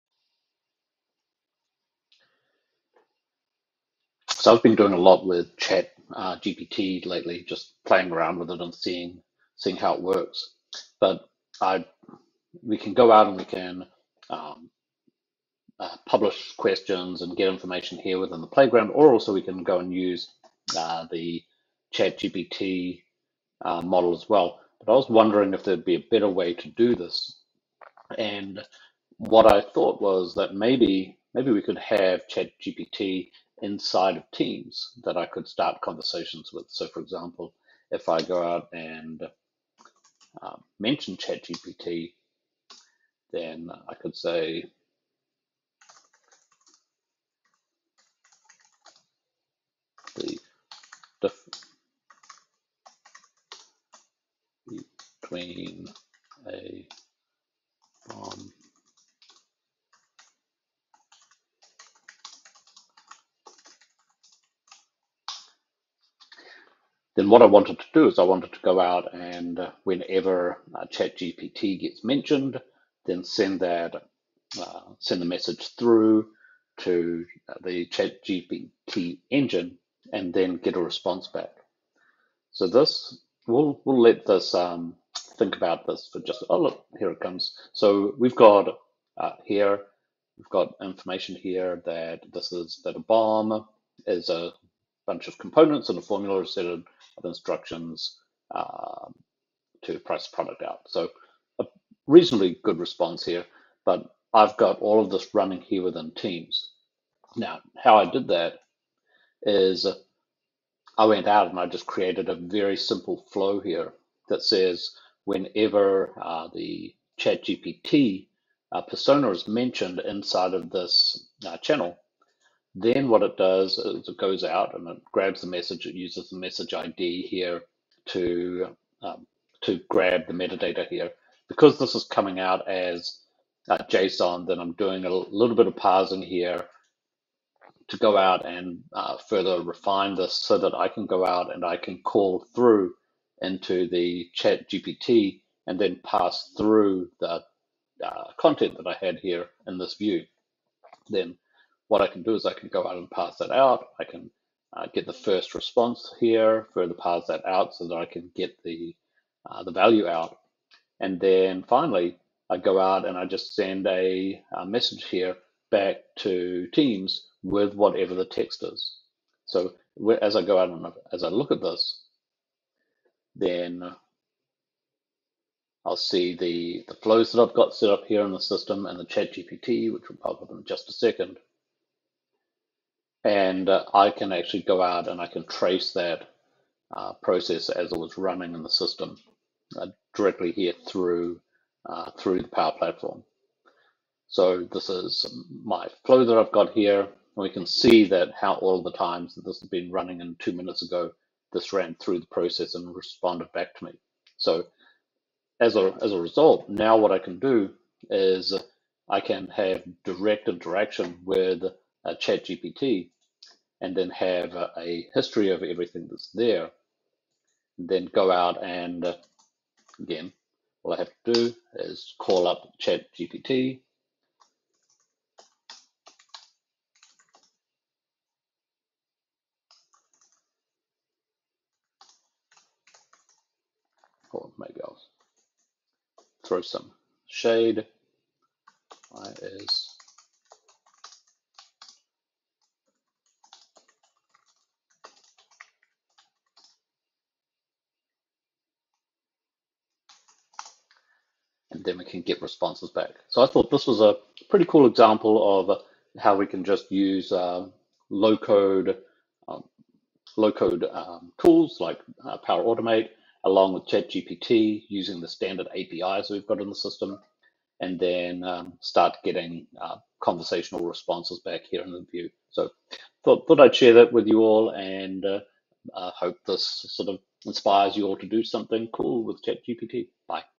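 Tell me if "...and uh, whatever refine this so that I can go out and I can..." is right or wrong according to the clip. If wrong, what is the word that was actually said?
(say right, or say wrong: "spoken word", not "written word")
wrong: "further", not "whatever".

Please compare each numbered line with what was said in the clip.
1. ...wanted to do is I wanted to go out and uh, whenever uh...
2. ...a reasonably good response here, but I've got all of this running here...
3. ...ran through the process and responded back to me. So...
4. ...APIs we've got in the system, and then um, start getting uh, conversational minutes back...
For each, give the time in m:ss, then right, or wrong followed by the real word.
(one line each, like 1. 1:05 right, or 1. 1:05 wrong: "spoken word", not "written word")
1. 1:07 right
2. 1:41 right
3. 3:21 right
4. 4:25 wrong: "responses", not "minutes".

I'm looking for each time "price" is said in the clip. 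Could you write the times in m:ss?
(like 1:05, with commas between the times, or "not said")
1:39.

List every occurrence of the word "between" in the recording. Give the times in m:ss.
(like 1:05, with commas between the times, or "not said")
0:55.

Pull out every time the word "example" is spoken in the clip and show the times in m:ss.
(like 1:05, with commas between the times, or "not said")
0:36, 4:14.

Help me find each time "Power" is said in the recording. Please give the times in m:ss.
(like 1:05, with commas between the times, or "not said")
3:12, 4:22.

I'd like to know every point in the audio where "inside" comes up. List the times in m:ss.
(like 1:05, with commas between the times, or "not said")
0:33, 1:59.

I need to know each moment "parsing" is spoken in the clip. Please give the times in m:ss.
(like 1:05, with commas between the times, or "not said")
2:15.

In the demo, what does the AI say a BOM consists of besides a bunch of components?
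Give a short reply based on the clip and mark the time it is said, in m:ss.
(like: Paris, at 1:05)
a formula, at 1:35.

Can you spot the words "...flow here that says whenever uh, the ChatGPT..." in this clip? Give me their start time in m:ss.
1:53.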